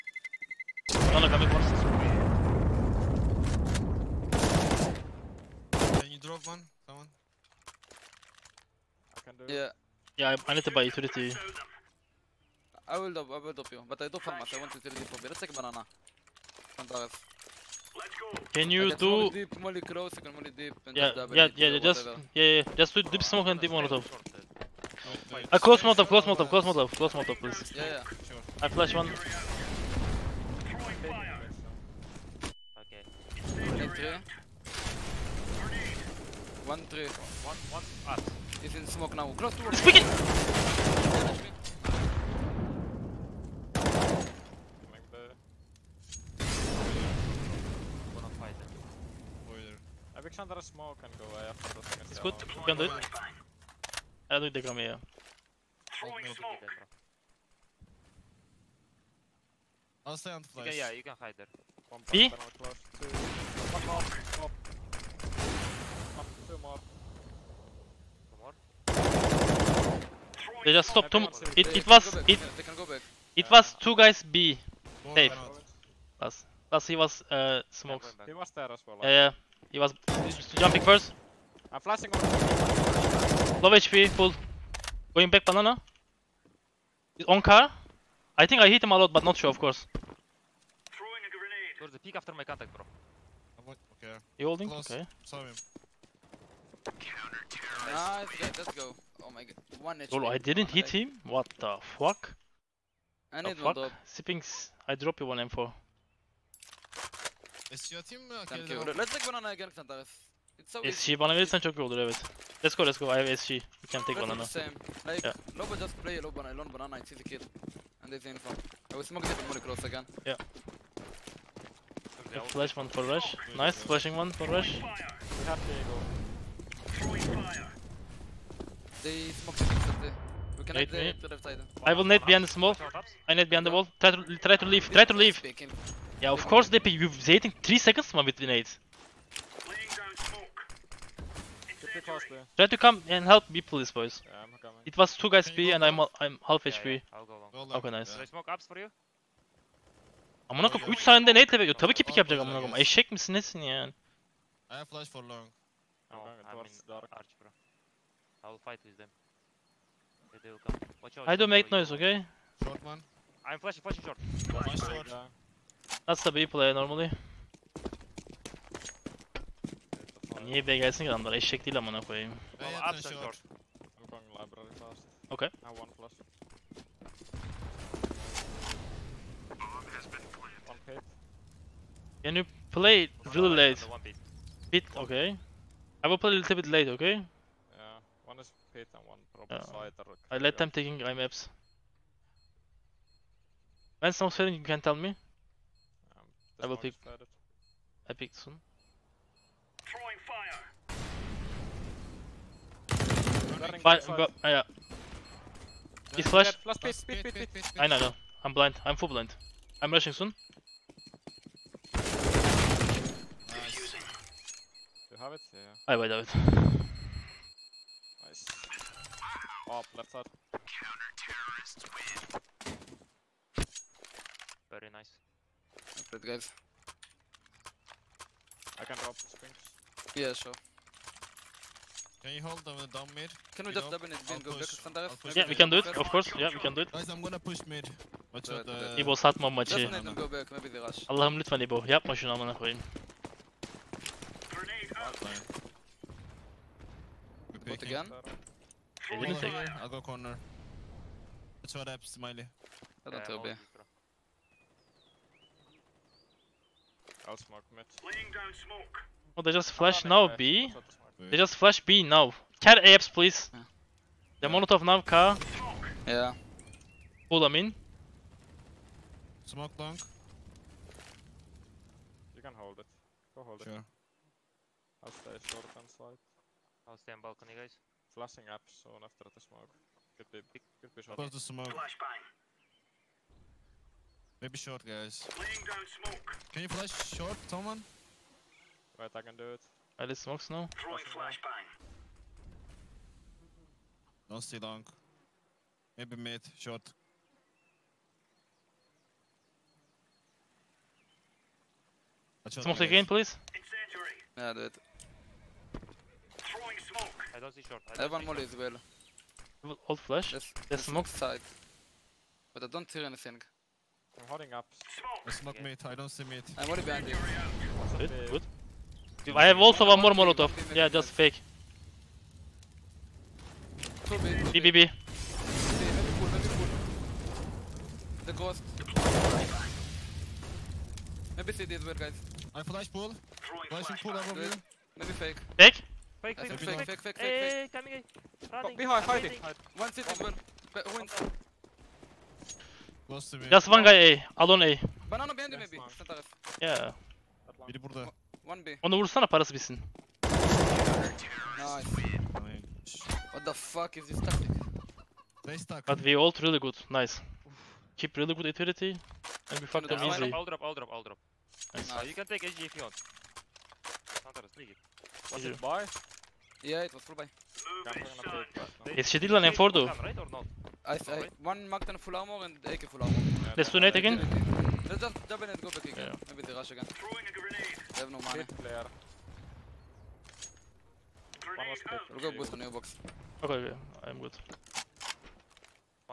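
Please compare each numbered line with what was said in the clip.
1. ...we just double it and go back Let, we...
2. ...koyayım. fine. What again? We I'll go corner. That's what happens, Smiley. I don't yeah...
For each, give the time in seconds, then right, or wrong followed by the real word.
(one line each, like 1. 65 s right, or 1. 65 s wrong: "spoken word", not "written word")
1. 233 s wrong: "Yeah", not "Let"
2. 242 s right.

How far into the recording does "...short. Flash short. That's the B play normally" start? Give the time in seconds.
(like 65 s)
164 s.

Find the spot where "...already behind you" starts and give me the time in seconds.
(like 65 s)
316 s.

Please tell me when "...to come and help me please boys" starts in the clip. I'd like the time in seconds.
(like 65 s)
142 s.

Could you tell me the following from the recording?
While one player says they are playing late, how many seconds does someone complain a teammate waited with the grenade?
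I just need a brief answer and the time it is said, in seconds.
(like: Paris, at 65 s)
3, at 137 s.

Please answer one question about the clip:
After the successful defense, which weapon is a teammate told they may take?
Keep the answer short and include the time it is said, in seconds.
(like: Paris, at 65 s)
AG, at 362 s.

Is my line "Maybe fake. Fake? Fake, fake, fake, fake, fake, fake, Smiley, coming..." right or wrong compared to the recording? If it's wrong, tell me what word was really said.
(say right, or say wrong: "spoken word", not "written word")
wrong: "Hey", not "Smiley".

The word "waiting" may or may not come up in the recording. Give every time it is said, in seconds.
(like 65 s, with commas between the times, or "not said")
137 s.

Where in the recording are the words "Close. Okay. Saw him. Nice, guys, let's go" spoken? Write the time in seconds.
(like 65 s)
94 s.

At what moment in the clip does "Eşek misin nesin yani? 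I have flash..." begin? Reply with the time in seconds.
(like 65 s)
152 s.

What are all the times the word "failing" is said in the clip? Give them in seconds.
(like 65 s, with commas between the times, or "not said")
194 s.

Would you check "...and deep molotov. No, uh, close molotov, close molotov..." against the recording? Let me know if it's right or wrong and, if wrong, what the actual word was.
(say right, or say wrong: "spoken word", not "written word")
right.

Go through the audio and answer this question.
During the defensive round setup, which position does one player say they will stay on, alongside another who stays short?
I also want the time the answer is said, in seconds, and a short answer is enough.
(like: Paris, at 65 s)
balcony, at 277 s.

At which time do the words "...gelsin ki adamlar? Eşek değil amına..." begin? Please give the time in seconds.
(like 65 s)
170 s.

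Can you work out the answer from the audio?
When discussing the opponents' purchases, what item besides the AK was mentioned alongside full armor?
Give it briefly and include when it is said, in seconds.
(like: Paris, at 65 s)
Magdan, at 371 s.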